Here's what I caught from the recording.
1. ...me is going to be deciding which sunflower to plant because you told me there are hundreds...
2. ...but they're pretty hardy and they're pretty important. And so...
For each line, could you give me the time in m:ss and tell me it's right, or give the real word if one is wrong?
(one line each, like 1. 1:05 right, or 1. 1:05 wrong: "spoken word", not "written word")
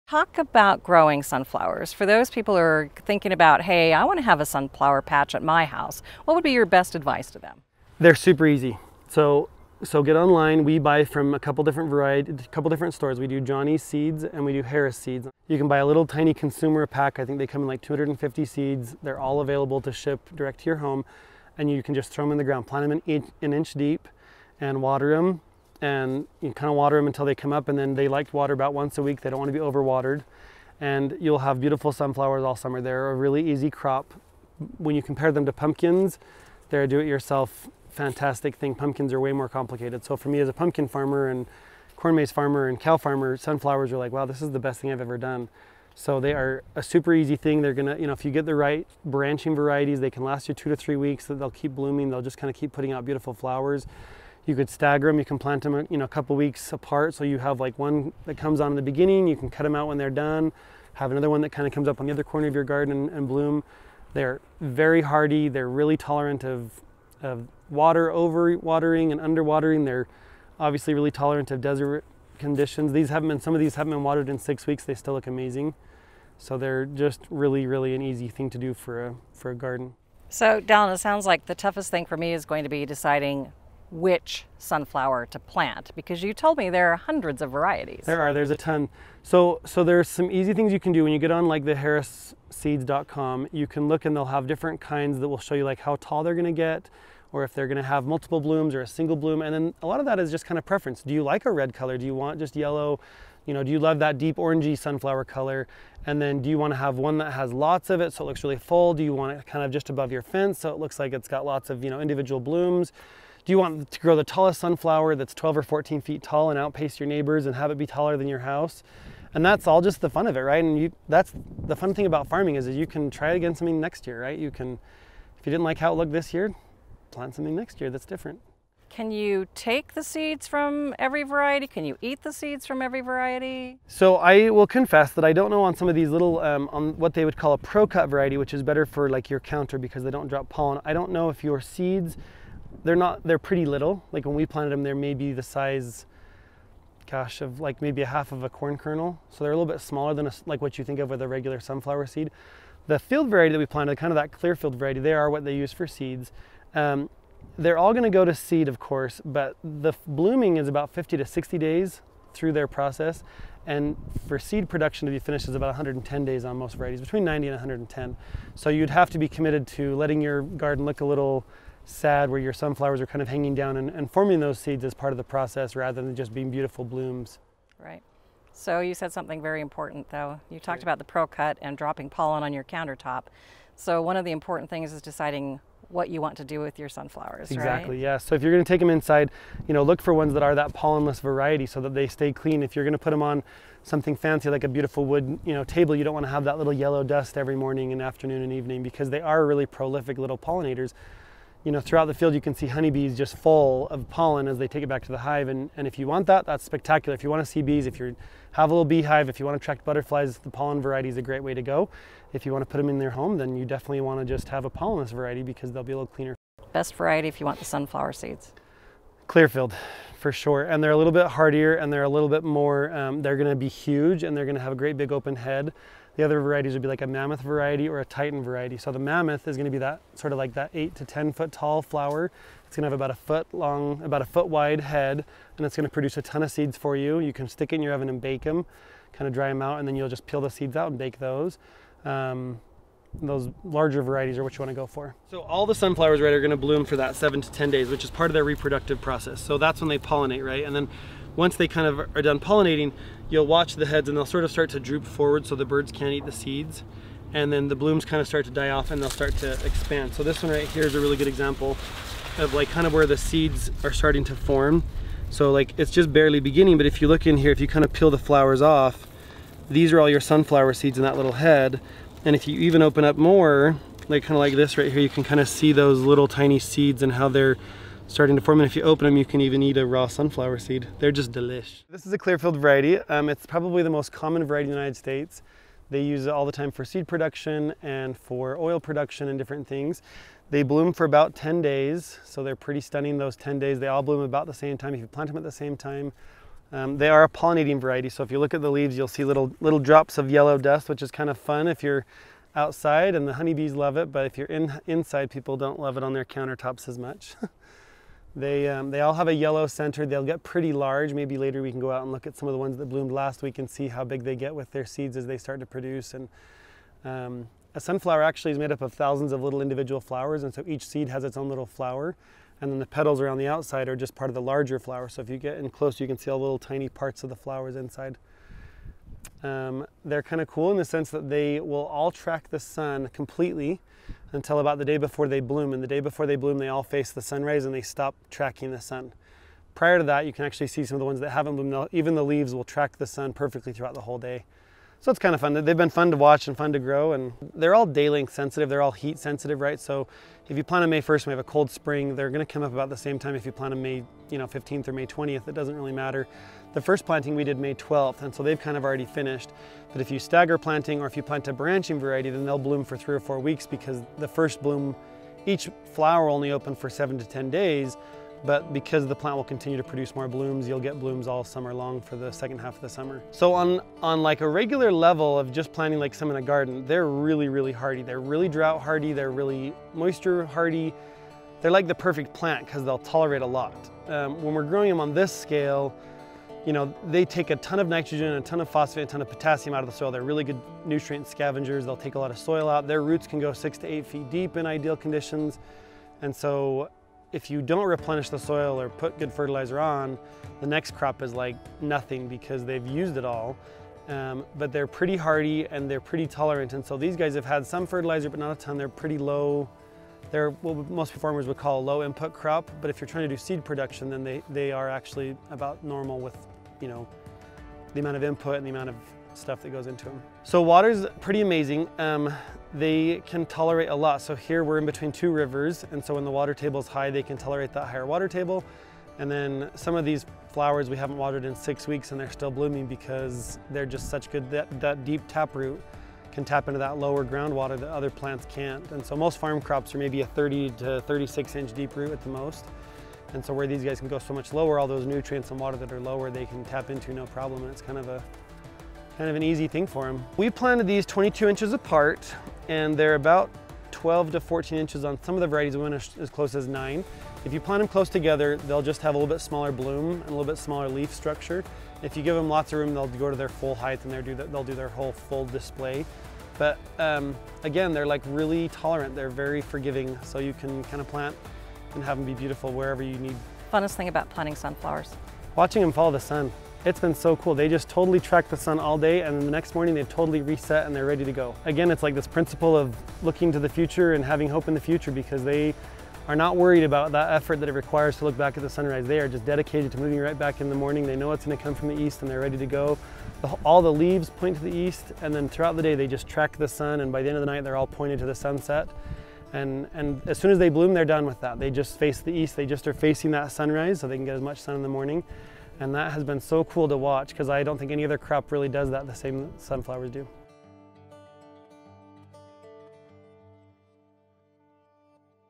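1. 1:22 right
2. 6:44 wrong: "tolerant", not "important".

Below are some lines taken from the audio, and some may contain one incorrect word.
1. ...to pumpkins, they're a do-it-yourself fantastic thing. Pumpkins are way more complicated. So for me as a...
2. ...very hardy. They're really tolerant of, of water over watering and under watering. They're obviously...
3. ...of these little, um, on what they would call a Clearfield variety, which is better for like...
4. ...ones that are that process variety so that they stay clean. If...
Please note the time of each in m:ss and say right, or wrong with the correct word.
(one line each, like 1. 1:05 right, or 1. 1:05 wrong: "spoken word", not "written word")
1. 0:35 right
2. 1:04 right
3. 2:15 wrong: "ProCut", not "Clearfield"
4. 3:10 wrong: "pollenless", not "process".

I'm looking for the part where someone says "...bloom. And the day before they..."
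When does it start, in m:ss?
5:35.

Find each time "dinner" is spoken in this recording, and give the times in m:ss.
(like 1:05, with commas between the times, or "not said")
not said.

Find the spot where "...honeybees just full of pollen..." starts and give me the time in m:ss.
3:22.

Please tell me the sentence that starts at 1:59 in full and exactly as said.
And that's all just the fun of it, right?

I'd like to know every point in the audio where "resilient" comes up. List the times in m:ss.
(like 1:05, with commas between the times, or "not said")
not said.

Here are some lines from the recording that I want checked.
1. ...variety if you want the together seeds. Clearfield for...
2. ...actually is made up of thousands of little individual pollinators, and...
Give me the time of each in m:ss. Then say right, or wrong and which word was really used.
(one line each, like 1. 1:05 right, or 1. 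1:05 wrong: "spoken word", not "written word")
1. 3:36 wrong: "sunflower", not "together"
2. 5:18 wrong: "flowers", not "pollinators".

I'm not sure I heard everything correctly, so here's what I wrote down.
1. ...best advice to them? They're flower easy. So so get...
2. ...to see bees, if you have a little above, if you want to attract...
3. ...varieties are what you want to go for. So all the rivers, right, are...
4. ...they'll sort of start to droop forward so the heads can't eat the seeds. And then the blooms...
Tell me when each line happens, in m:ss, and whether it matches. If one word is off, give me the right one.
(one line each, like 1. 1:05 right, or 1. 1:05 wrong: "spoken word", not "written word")
1. 0:06 wrong: "super", not "flower"
2. 3:27 wrong: "beehive", not "above"
3. 4:04 wrong: "sunflowers", not "rivers"
4. 4:14 wrong: "birds", not "heads".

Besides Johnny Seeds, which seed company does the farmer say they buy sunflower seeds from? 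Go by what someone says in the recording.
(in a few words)
Harris Seeds.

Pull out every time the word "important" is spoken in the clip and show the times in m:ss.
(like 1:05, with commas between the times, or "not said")
2:59, 3:04.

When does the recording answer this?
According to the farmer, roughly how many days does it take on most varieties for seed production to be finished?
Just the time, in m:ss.
2:45.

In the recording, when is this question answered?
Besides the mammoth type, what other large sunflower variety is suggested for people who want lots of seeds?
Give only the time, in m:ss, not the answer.
3:48.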